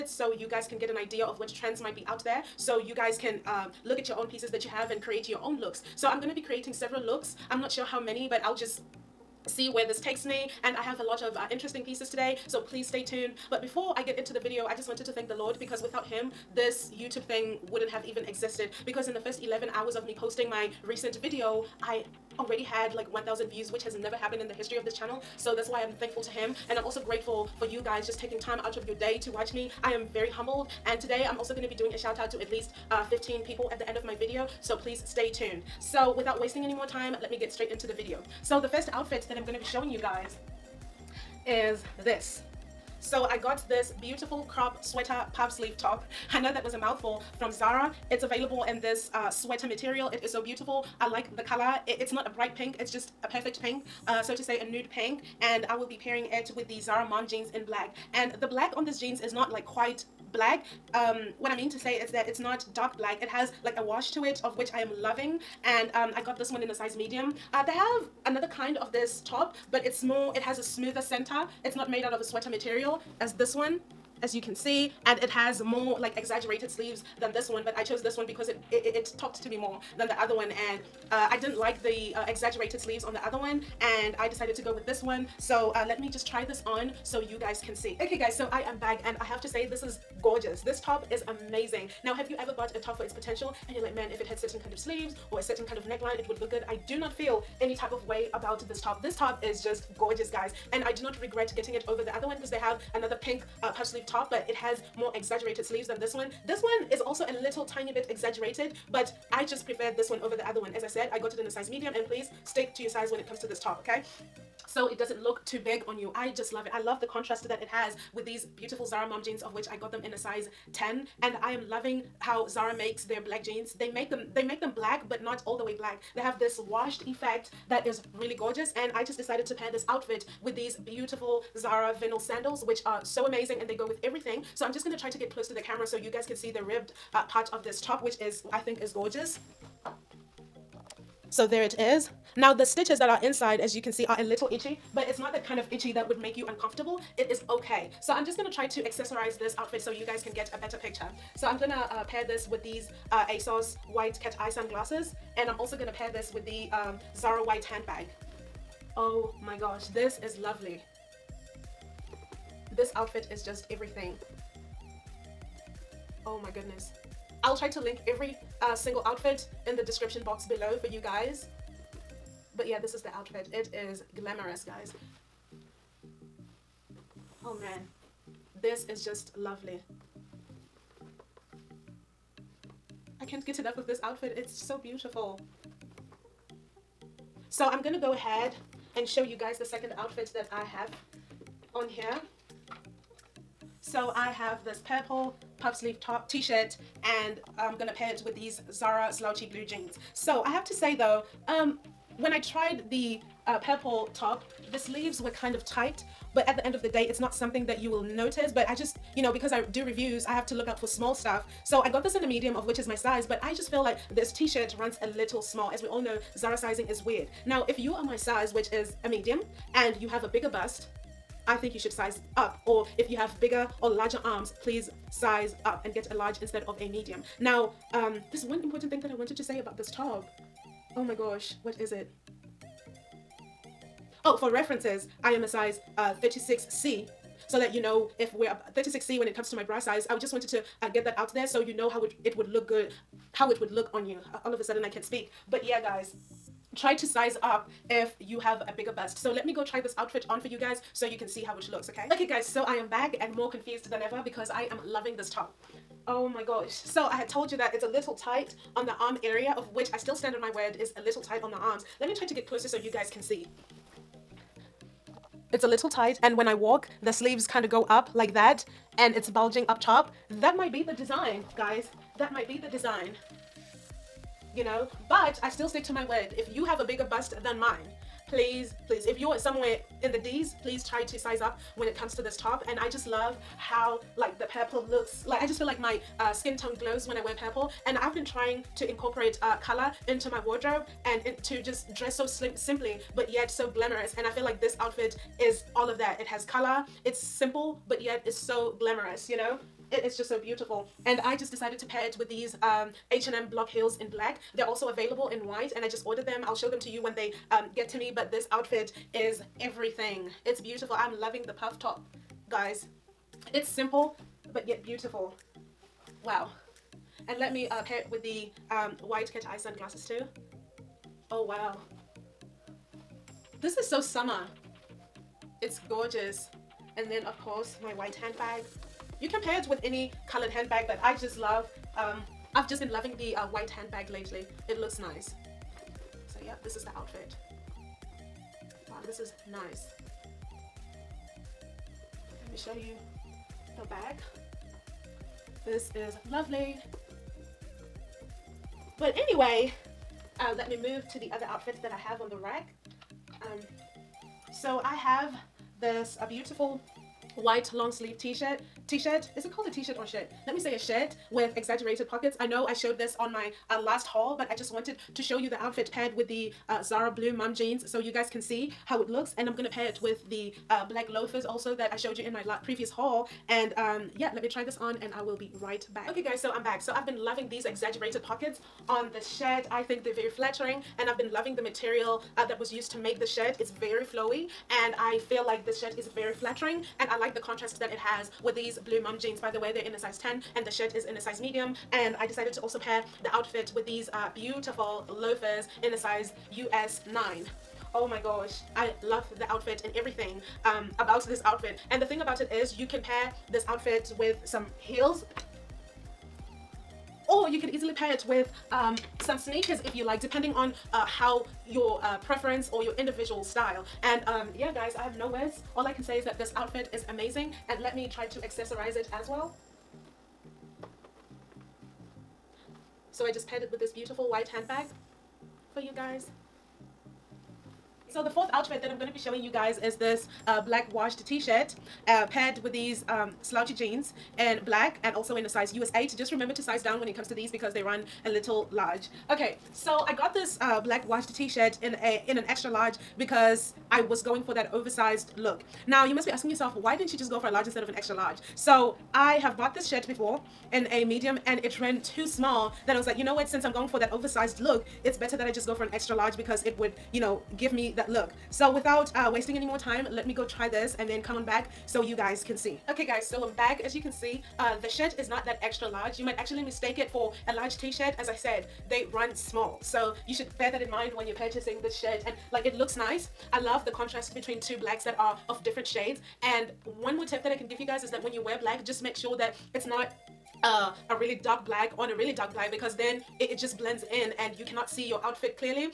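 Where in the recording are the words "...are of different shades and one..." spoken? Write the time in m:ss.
7:55.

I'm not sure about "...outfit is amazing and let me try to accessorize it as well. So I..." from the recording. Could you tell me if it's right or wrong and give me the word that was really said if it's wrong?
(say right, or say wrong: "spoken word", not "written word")
right.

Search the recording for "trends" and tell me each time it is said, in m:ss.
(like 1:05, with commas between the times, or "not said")
0:01.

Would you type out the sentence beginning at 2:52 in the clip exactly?
But yeah, this is the outfit.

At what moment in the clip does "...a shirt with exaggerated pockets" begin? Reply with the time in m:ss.
6:00.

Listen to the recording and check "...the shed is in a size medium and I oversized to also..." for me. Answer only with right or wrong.
wrong.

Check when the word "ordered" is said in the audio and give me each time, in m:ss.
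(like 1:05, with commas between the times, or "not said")
5:06.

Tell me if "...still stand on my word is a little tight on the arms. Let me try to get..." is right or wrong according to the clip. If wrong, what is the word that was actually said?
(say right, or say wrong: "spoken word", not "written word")
right.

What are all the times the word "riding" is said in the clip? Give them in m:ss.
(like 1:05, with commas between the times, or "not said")
not said.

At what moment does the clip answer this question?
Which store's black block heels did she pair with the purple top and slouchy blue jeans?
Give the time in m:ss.
5:03.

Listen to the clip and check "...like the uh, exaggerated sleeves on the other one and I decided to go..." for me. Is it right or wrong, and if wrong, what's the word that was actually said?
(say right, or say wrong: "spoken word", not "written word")
right.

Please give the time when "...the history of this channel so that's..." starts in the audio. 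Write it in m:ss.
0:24.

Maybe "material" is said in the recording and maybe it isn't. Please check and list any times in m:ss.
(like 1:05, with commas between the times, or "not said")
0:49, 1:12, 6:21.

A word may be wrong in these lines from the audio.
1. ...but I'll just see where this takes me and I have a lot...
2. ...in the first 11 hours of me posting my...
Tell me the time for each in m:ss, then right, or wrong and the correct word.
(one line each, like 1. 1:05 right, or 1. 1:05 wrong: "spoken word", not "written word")
1. 0:08 right
2. 0:19 right.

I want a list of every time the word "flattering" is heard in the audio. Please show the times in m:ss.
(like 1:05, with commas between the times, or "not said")
6:20, 6:26.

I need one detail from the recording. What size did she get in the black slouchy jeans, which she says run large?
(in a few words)
US 8.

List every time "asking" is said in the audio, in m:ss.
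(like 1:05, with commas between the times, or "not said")
7:26.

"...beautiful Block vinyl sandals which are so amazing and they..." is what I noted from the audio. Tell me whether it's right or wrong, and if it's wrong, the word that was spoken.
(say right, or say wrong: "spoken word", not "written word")
wrong: "Zara", not "Block".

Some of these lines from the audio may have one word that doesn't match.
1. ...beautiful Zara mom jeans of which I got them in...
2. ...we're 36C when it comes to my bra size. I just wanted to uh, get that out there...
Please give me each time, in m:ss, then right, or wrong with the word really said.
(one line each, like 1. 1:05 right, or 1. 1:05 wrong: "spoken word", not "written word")
1. 1:58 right
2. 3:58 right.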